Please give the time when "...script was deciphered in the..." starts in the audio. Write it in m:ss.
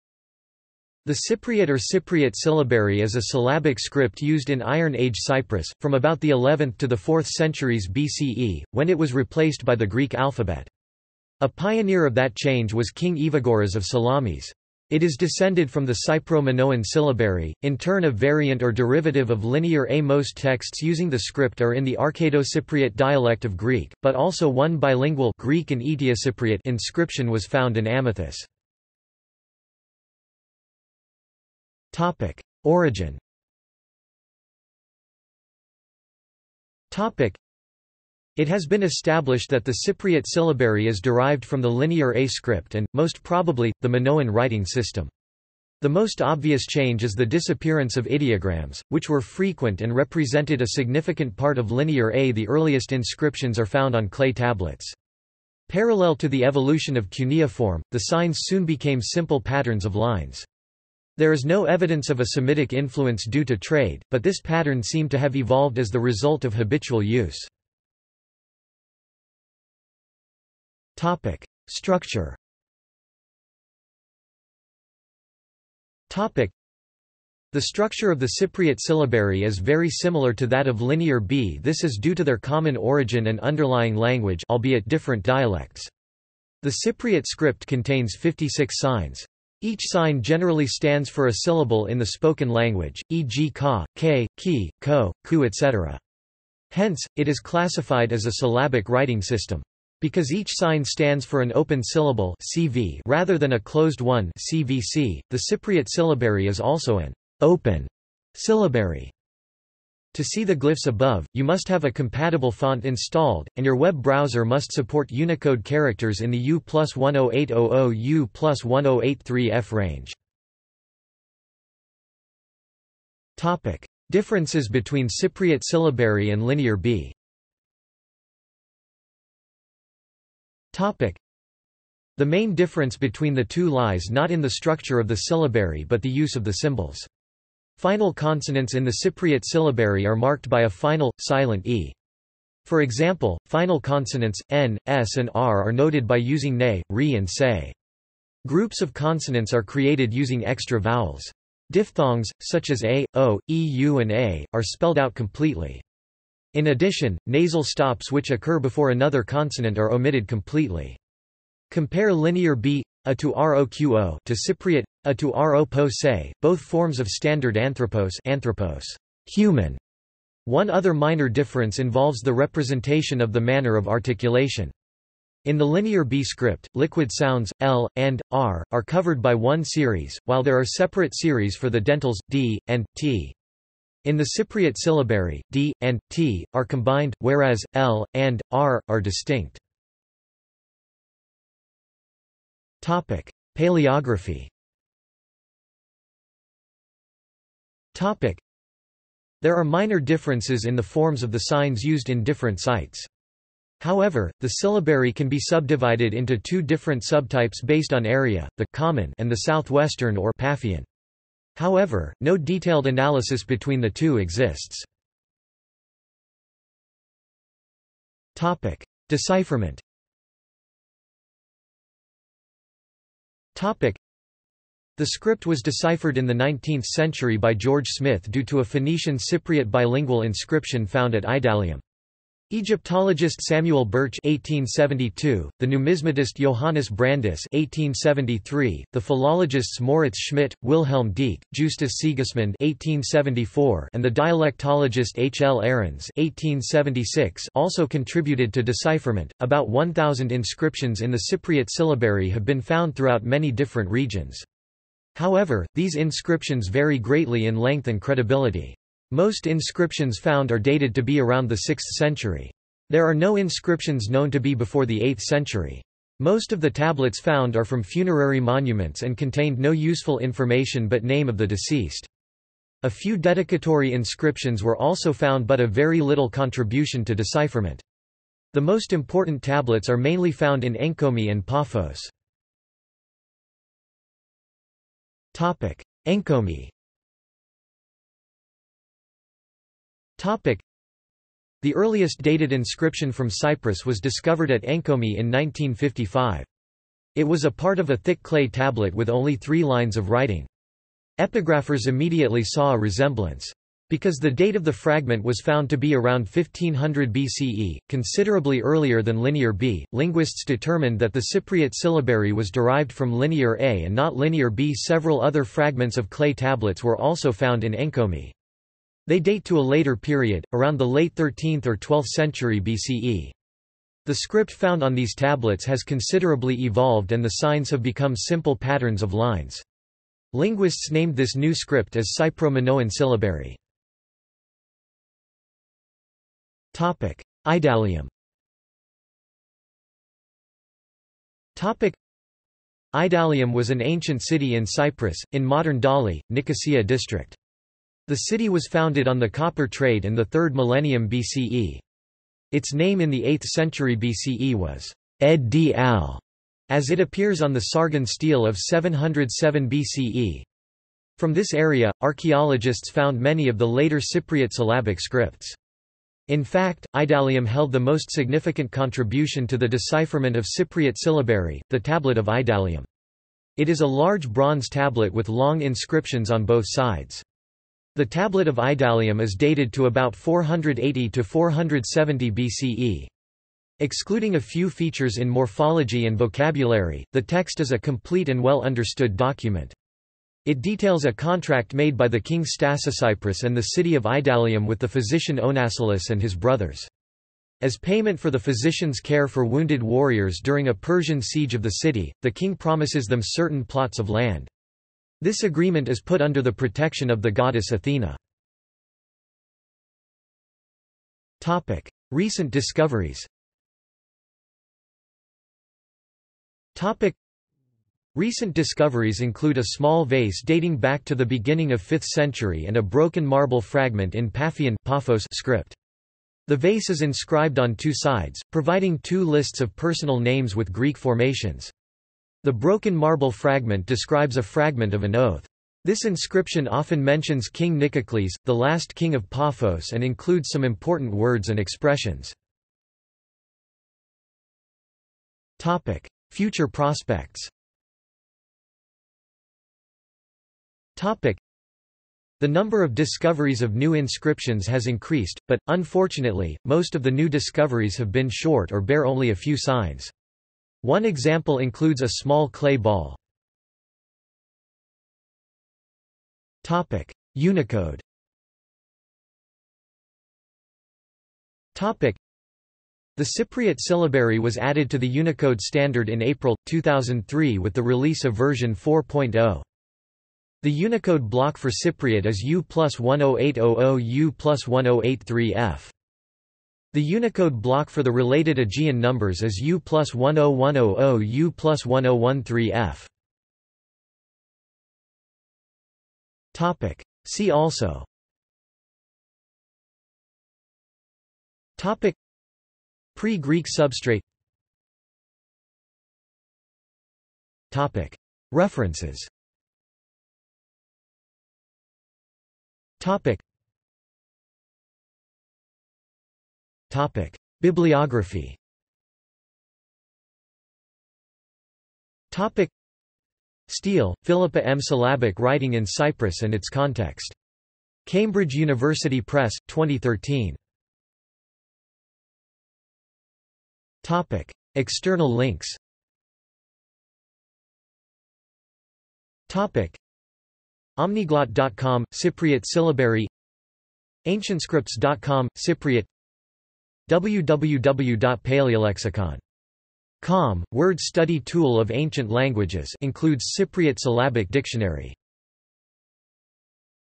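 3:45.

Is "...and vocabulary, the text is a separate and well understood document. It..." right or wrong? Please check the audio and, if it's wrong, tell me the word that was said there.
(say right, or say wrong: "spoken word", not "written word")
wrong: "complete", not "separate".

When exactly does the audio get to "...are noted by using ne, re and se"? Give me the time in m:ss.
2:25.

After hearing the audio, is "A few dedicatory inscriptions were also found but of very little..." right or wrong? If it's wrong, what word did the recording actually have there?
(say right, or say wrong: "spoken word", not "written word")
right.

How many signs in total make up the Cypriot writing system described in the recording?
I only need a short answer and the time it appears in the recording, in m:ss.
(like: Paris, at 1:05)
56, at 1:28.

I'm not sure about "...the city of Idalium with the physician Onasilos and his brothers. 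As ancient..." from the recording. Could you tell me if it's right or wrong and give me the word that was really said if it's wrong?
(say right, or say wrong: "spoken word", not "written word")
wrong: "payment", not "ancient".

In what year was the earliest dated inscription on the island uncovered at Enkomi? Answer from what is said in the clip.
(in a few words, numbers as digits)
1955.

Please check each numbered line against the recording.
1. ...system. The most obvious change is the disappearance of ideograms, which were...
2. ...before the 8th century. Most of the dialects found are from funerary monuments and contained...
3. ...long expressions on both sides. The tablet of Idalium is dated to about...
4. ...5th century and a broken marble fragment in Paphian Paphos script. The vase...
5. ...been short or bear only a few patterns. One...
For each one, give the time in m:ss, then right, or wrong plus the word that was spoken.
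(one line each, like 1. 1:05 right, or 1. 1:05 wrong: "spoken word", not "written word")
1. 0:44 right
2. 4:24 wrong: "tablets", not "dialects"
3. 6:15 wrong: "inscriptions", not "expressions"
4. 7:01 right
5. 7:38 wrong: "signs", not "patterns".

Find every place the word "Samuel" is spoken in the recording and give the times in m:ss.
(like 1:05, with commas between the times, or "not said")
3:53.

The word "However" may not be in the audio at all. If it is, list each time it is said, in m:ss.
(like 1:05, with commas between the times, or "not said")
3:23, 3:31, 4:15.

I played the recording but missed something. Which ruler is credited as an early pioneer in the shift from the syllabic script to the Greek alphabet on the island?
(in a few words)
Evagoras of Salamis.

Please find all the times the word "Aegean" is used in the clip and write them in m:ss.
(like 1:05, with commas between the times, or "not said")
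8:08.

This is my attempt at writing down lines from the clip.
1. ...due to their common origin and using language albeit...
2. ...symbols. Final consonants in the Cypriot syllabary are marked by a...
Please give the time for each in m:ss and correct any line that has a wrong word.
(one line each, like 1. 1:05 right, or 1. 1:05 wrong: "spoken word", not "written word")
1. 1:22 wrong: "underlying", not "using"
2. 2:16 right.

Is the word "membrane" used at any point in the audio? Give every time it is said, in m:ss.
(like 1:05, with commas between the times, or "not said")
not said.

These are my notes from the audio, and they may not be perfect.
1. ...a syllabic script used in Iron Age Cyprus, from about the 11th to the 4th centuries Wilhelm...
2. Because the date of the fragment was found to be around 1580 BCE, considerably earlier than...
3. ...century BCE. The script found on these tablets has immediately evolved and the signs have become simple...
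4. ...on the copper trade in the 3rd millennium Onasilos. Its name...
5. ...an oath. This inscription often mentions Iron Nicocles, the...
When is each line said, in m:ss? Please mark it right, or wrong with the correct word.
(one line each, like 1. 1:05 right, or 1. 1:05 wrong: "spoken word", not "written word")
1. 0:03 wrong: "BCE", not "Wilhelm"
2. 5:03 wrong: "1500", not "1580"
3. 5:22 wrong: "considerably", not "immediately"
4. 5:49 wrong: "BCE", not "Onasilos"
5. 7:15 wrong: "King", not "Iron".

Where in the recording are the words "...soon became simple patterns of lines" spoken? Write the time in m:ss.
0:58.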